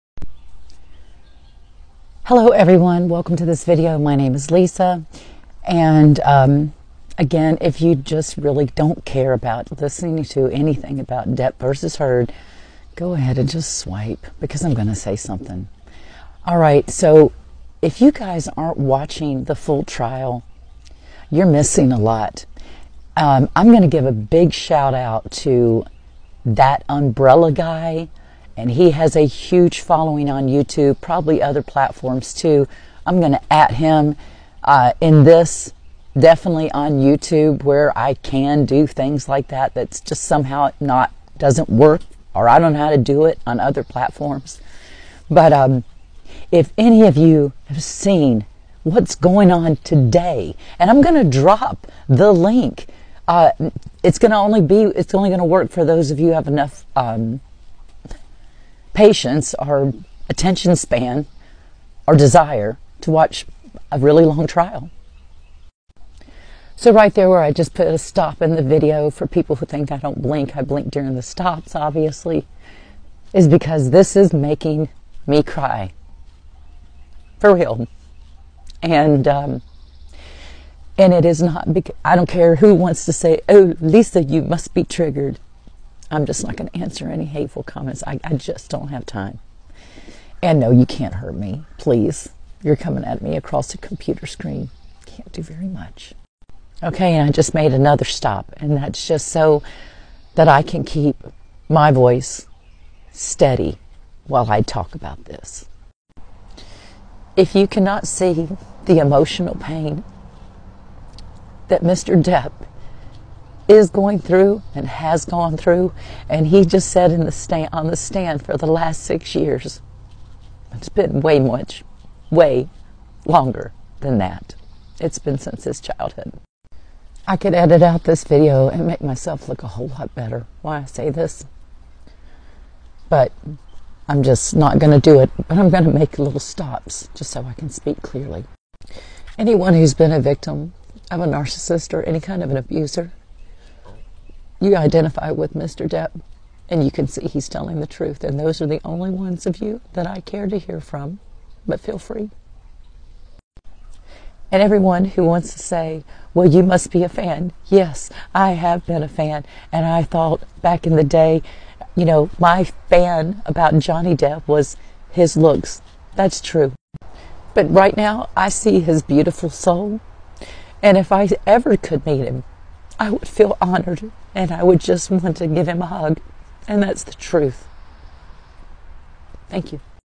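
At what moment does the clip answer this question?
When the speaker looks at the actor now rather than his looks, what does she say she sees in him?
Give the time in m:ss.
2:48.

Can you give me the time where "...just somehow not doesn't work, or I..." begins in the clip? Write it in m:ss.
0:39.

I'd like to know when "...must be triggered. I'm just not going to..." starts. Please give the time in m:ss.
1:24.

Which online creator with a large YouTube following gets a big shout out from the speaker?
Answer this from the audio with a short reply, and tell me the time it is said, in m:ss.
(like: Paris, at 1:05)
That umbrella guy, at 0:26.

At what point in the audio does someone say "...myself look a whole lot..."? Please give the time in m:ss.
2:09.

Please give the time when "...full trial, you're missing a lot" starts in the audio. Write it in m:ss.
0:19.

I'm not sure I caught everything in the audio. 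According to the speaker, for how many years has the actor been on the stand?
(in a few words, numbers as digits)
6.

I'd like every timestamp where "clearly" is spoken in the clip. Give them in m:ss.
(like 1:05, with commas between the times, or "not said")
2:18.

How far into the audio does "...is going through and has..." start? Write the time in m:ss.
1:53.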